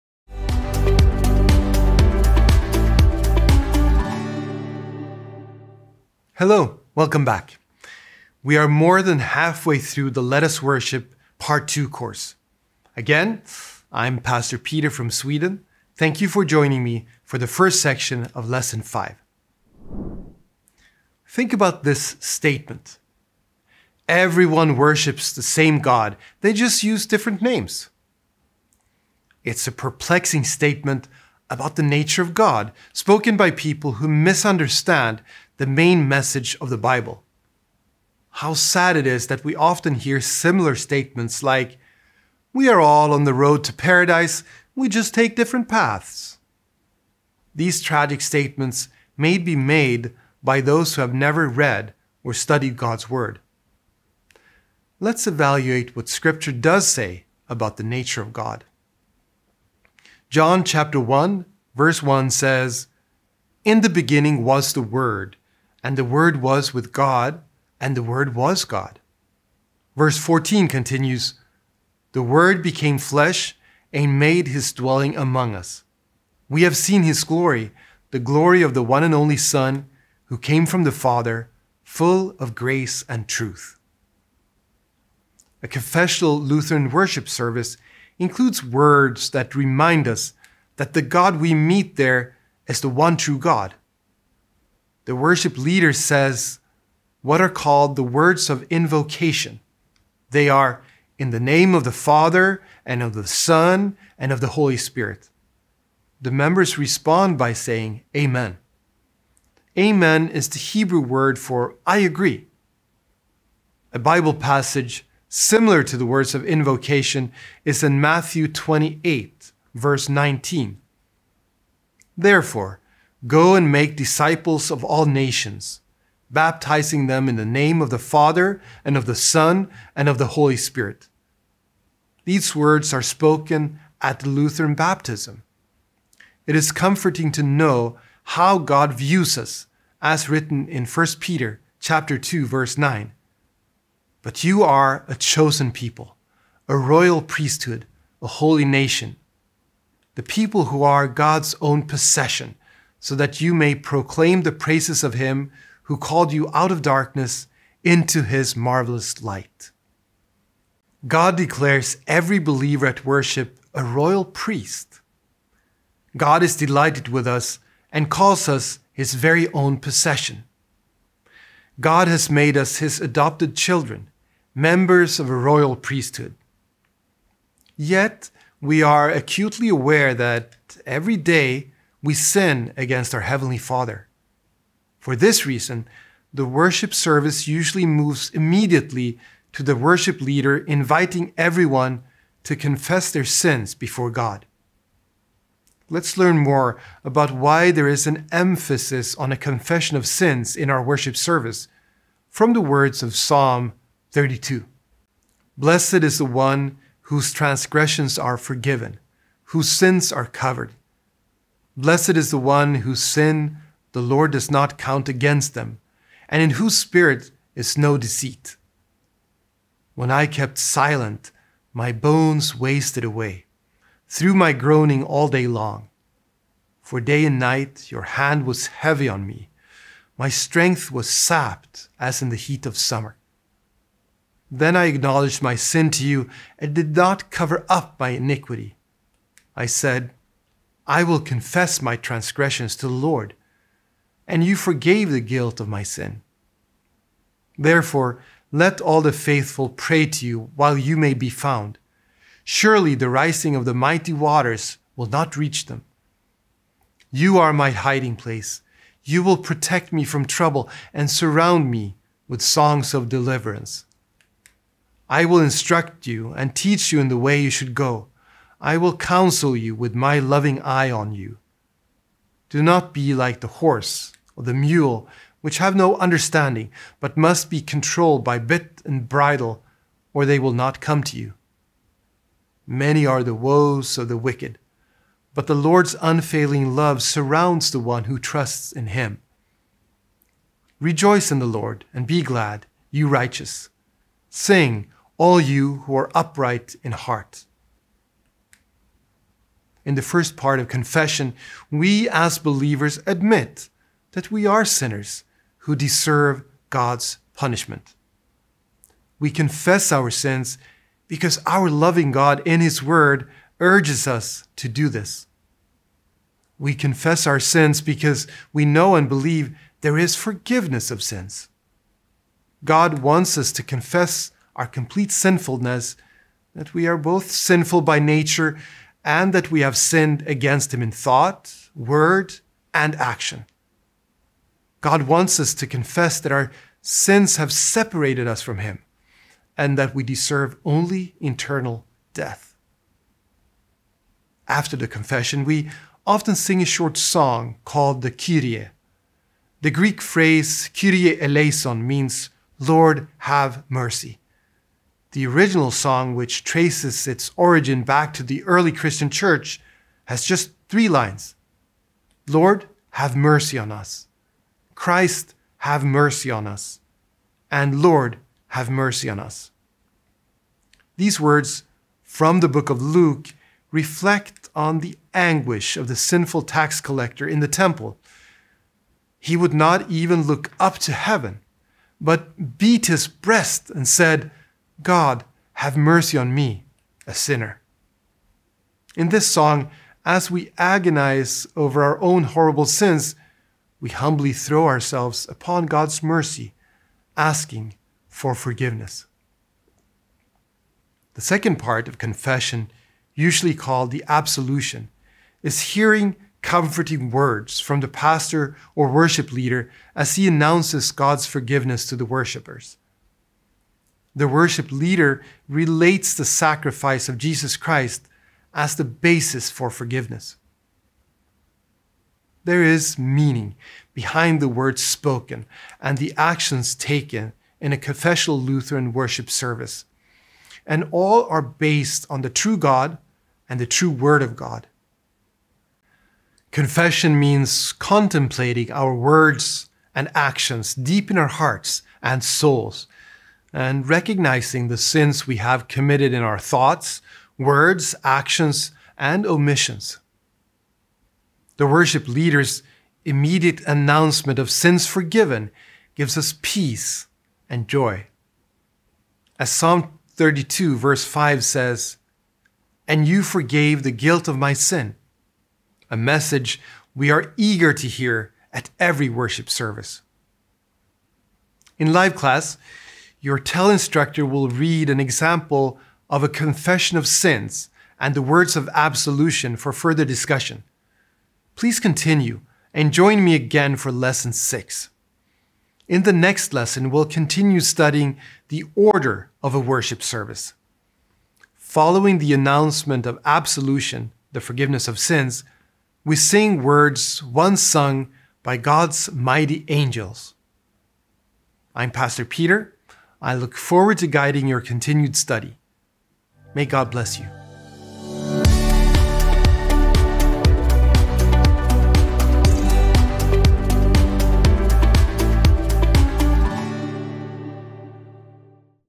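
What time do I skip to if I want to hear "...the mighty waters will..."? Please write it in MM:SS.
04:13.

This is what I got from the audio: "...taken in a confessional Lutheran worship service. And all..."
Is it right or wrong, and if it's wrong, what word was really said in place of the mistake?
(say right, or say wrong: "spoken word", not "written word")
right.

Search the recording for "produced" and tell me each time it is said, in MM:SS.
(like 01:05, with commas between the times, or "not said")
not said.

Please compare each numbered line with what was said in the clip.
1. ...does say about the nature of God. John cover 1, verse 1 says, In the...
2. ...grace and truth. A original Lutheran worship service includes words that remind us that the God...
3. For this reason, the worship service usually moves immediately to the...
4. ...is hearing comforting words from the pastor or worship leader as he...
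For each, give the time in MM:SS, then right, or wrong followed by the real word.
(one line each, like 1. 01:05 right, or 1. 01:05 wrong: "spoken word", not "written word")
1. 00:56 wrong: "chapter", not "cover"
2. 01:22 wrong: "confessional", not "original"
3. 03:04 right
4. 06:45 right.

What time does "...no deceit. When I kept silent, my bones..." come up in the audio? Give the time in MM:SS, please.
03:37.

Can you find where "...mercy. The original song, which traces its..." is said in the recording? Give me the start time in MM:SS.
05:53.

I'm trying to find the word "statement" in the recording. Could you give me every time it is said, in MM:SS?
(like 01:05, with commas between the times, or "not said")
00:22, 00:30, 00:40, 00:48.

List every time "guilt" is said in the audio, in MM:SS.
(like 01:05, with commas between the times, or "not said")
04:05, 07:43.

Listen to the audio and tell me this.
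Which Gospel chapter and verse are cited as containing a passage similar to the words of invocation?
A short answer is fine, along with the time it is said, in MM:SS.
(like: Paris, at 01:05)
Matthew 28:19, at 01:58.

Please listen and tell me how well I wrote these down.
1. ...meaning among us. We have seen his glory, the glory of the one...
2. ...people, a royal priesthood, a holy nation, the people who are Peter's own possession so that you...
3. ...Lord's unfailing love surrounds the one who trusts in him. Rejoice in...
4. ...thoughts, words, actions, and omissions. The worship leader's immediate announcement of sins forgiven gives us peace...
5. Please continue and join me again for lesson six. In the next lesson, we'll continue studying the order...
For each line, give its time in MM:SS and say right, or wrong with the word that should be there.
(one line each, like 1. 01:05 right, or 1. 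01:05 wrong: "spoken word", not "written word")
1. 01:14 wrong: "dwelling", not "meaning"
2. 02:25 wrong: "God", not "Peter"
3. 04:45 right
4. 07:26 right
5. 08:01 right.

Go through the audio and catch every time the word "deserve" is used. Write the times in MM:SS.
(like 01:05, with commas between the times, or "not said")
05:05, 05:40.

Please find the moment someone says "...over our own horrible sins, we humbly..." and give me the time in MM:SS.
06:31.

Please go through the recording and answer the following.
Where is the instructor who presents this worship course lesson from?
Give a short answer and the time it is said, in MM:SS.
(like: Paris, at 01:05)
Sweden, at 00:15.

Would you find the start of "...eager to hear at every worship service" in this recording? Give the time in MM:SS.
07:47.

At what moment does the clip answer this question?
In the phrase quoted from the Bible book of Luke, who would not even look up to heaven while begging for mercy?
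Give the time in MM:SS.
06:15.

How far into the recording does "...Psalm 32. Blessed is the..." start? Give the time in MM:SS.
03:23.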